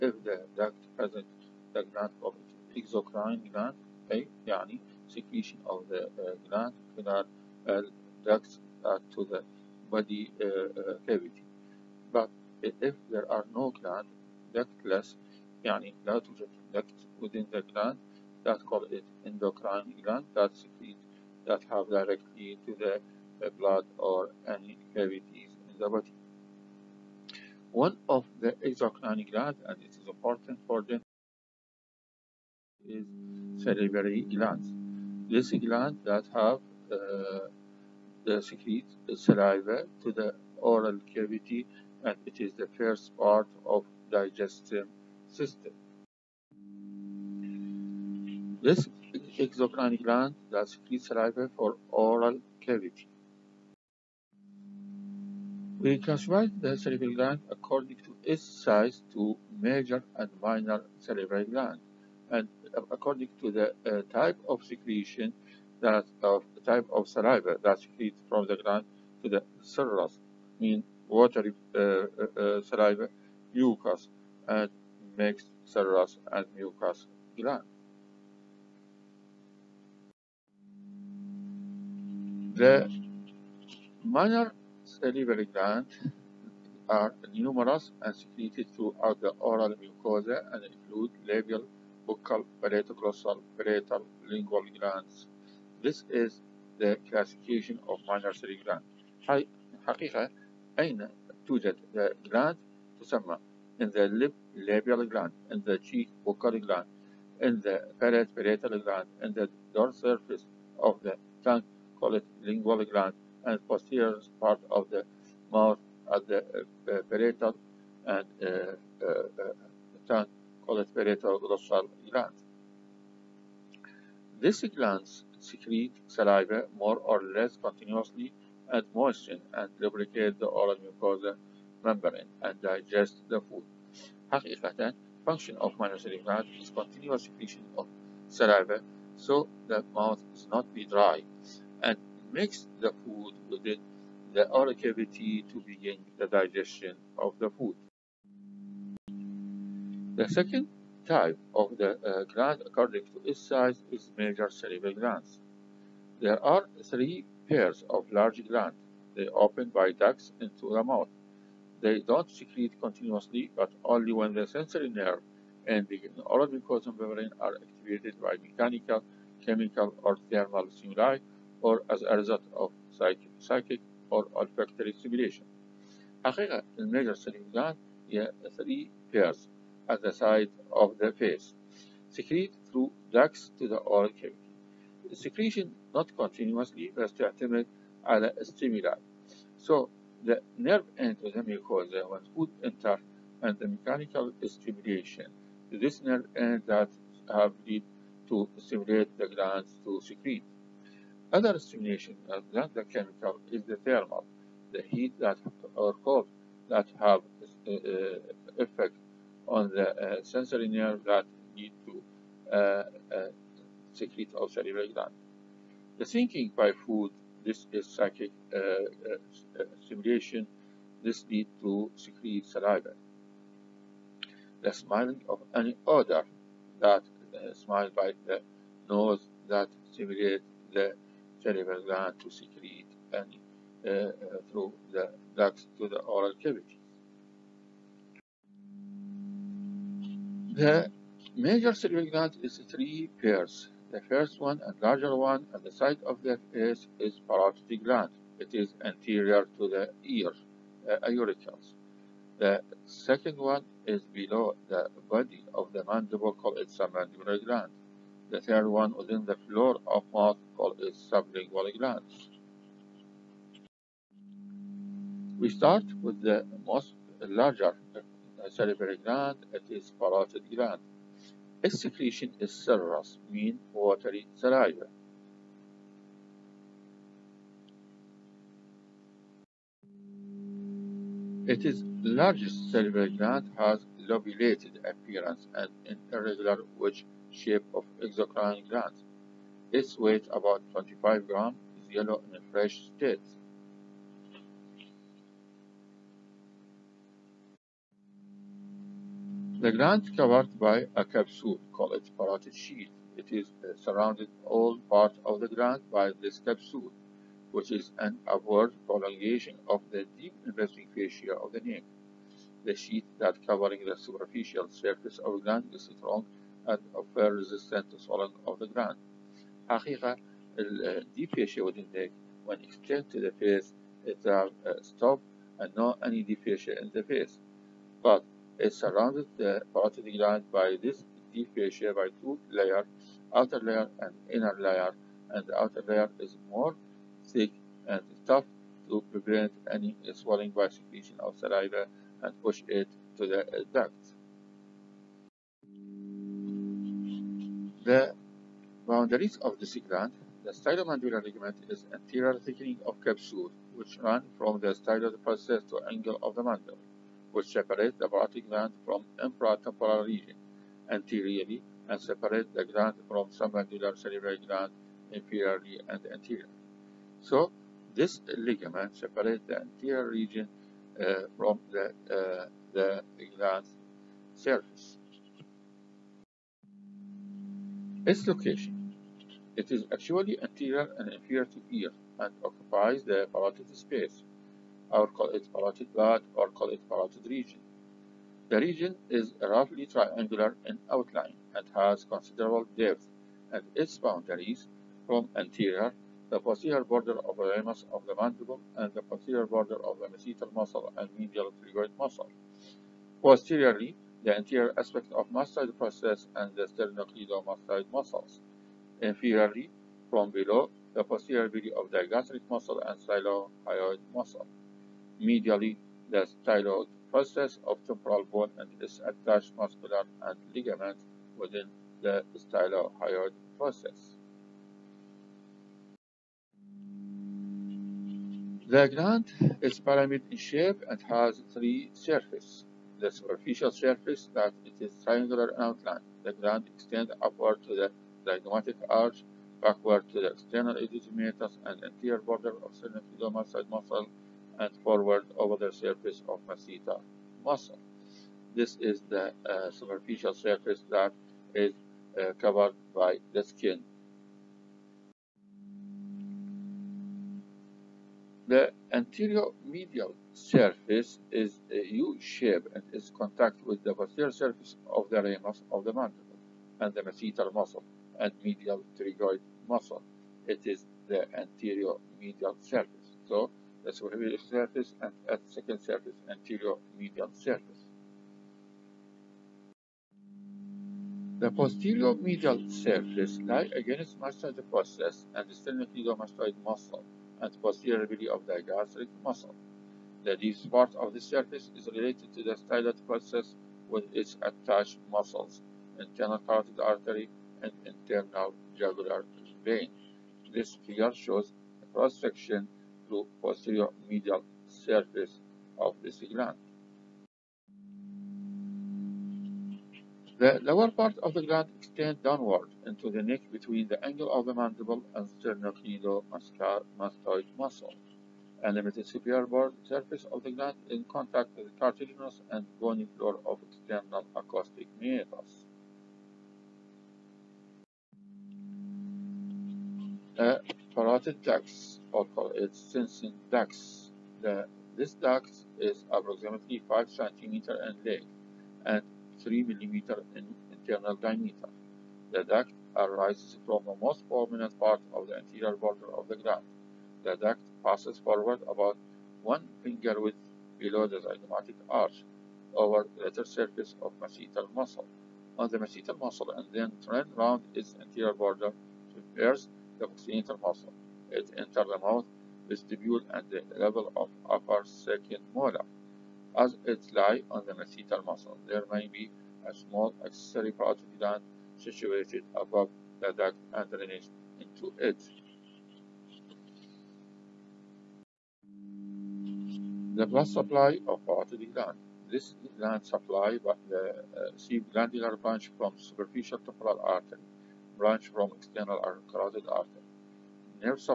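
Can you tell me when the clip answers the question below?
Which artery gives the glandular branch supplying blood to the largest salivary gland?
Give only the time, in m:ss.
9:45.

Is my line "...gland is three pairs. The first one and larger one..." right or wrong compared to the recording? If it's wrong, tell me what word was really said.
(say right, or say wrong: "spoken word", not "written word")
right.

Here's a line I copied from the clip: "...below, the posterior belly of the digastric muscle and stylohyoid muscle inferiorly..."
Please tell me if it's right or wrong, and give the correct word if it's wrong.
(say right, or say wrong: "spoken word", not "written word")
wrong: "medially", not "inferiorly".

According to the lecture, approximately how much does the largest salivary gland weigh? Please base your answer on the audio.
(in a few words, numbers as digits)
25 grams.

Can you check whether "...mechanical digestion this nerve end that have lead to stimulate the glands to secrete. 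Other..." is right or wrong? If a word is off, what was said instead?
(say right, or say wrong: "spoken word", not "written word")
wrong: "stimulation", not "digestion".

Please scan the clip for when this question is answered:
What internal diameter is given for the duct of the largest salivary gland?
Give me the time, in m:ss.
8:59.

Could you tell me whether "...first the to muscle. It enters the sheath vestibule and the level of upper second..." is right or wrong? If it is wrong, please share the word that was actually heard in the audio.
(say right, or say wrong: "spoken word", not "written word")
wrong: "mouth", not "sheath".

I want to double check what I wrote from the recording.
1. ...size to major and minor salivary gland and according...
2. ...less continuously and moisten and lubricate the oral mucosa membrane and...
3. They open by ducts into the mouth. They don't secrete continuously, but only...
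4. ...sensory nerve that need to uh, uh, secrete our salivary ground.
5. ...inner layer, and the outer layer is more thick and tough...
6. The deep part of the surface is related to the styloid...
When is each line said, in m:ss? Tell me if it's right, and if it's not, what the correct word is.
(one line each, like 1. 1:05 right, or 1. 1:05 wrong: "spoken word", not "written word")
1. 0:58 right
2. 2:07 right
3. 2:39 right
4. 3:30 wrong: "gland", not "ground"
5. 5:34 right
6. 8:10 right.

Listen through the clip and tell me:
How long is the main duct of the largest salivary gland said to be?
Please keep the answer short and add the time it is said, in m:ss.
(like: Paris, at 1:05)
5 centimeters, at 8:56.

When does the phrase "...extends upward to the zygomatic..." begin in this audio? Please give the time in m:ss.
7:16.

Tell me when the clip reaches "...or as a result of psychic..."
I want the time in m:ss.
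2:51.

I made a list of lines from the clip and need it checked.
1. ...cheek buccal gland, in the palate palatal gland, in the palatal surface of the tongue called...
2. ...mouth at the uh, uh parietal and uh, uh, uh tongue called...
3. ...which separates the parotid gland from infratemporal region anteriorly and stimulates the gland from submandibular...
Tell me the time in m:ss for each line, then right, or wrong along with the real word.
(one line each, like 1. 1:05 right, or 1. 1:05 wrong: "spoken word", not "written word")
1. 1:45 wrong: "dorsal", not "palatal"
2. 1:55 right
3. 5:57 wrong: "separates", not "stimulates".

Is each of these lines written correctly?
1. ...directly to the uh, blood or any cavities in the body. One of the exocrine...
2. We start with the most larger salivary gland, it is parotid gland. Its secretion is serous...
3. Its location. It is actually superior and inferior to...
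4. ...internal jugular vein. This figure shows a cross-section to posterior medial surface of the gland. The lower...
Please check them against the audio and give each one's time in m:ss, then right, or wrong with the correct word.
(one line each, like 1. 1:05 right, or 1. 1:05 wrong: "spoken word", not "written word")
1. 0:21 right
2. 4:25 right
3. 6:18 wrong: "anterior", not "superior"
4. 8:17 right.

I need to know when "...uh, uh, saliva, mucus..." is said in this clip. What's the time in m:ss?
1:11.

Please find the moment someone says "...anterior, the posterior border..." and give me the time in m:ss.
6:35.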